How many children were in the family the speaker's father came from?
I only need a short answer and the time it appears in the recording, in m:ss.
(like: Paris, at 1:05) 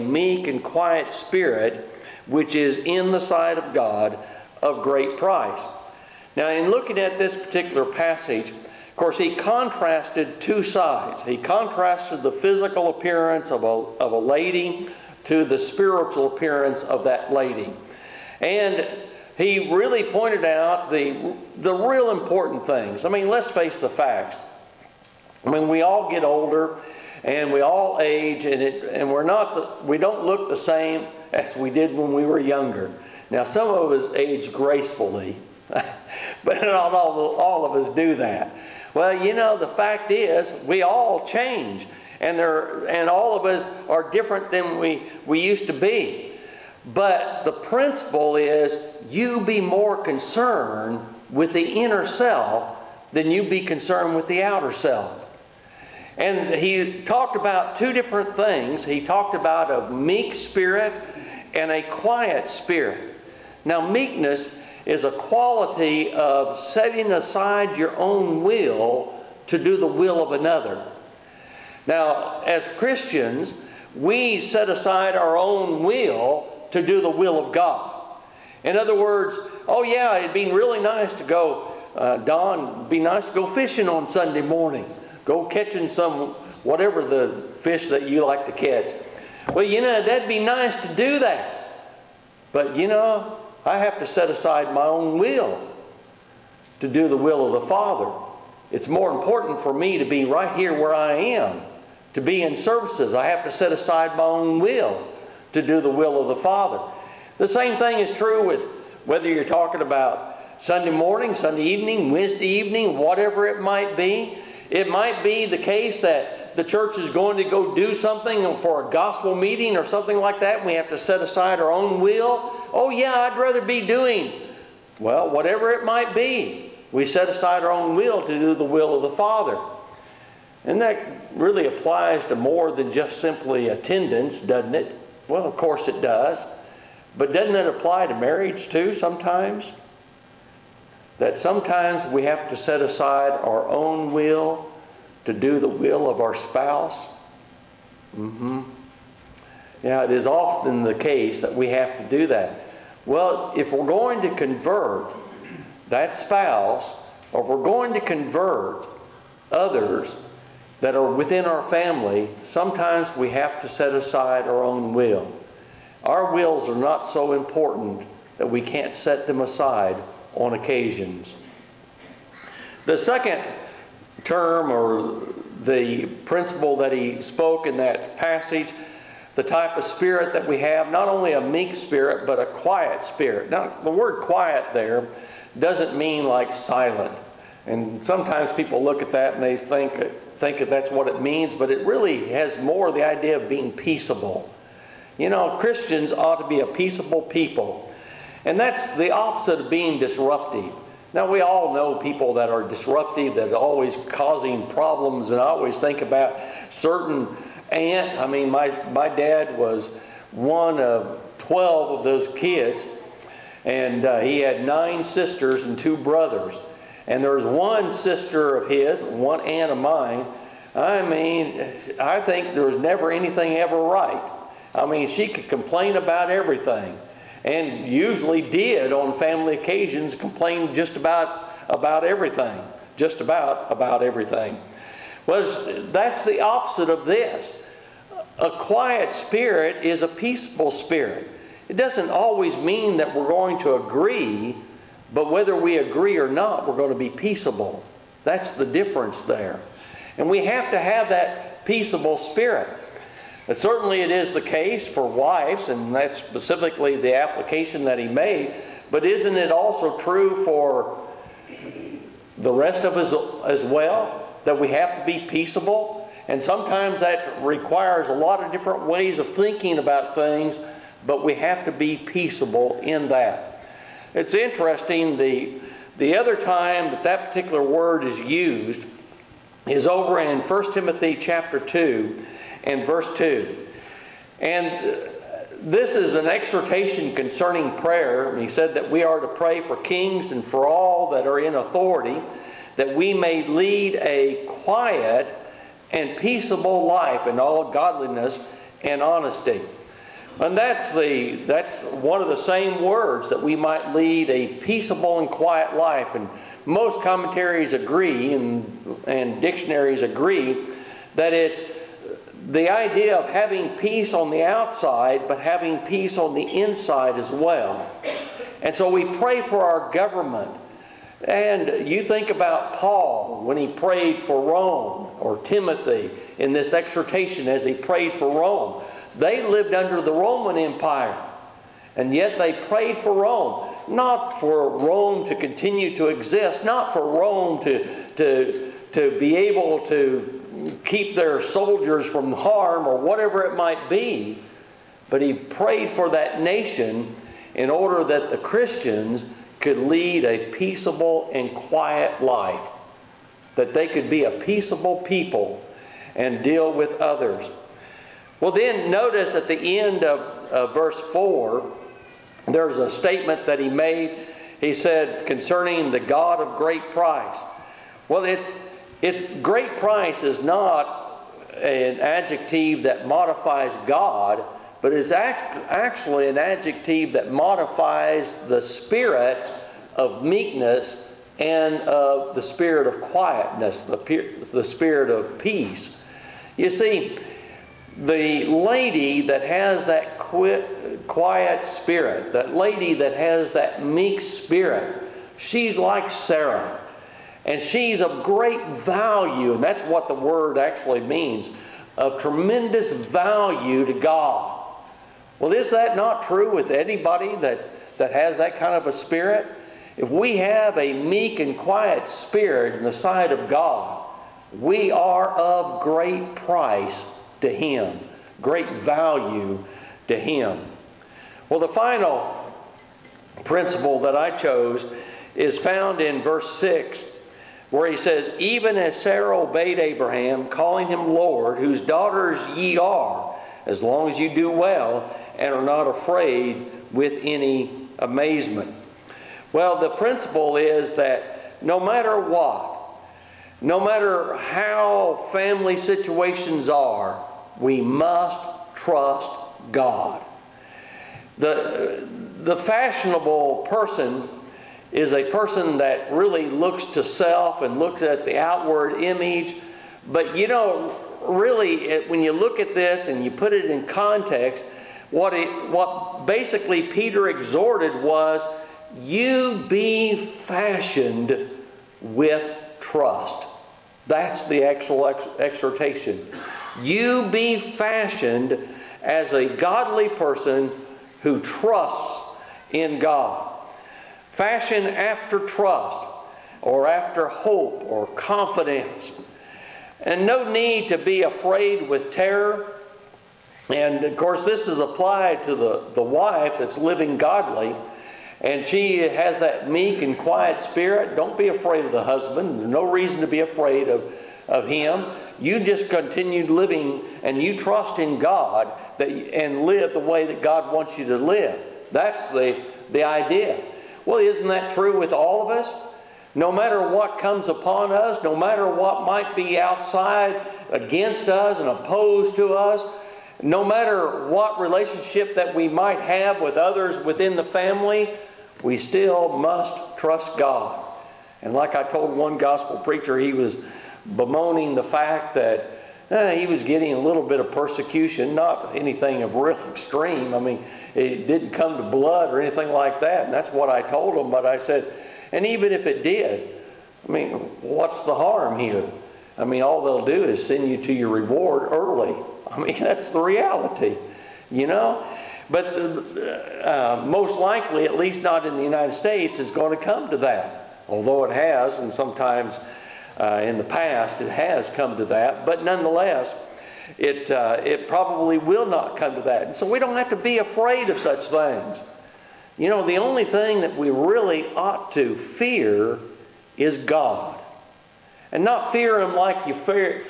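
12, at 3:31.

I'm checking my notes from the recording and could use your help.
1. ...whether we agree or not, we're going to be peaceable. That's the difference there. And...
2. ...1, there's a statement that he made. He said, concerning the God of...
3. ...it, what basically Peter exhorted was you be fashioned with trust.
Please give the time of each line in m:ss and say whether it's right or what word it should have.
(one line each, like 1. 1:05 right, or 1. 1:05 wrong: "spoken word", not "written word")
1. 4:05 right
2. 6:00 wrong: "4", not "1"
3. 7:45 right.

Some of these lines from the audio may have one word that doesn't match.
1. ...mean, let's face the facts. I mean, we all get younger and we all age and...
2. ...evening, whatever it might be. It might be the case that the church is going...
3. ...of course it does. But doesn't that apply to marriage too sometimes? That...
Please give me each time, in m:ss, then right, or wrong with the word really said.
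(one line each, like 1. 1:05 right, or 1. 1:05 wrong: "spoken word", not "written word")
1. 0:23 wrong: "older", not "younger"
2. 1:52 right
3. 2:15 right.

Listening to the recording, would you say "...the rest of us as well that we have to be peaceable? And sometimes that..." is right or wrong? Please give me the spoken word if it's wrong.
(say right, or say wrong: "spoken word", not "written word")
right.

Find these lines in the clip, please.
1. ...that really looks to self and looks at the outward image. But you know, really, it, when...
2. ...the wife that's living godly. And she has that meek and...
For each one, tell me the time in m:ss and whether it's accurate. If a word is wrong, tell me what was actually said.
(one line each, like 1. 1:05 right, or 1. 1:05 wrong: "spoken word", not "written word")
1. 7:35 right
2. 8:15 right.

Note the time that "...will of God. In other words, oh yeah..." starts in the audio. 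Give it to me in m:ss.
1:17.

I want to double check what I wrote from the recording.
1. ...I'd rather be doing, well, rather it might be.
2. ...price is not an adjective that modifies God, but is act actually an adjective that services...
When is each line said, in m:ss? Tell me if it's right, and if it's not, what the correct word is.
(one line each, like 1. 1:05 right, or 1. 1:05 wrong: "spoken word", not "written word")
1. 2:03 wrong: "whatever", not "rather"
2. 6:09 wrong: "modifies", not "services".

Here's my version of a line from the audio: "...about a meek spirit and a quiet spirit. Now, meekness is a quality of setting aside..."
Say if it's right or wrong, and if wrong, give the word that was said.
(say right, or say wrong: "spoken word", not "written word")
right.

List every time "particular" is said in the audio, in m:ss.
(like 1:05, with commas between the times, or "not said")
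0:07, 4:37.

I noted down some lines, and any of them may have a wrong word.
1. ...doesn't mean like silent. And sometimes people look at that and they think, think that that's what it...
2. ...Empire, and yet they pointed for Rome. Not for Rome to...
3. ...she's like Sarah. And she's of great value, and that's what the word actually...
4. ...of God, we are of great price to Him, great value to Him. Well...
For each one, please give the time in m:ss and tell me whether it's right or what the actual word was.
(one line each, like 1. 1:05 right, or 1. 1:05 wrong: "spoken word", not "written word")
1. 3:05 right
2. 5:30 wrong: "prayed", not "pointed"
3. 6:35 right
4. 6:53 right.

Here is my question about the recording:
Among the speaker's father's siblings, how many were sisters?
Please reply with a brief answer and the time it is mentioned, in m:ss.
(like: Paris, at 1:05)
Nine, at 3:34.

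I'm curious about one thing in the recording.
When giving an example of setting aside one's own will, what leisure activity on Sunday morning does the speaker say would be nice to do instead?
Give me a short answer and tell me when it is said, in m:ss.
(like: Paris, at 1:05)
Fishing, at 1:23.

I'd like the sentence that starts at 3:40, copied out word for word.
I mean, I think there was never anything ever right.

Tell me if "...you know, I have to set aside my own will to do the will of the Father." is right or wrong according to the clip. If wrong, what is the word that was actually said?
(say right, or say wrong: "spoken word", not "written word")
right.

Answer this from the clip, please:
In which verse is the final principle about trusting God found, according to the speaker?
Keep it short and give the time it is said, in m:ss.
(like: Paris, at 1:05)
Verse 6, at 7:06.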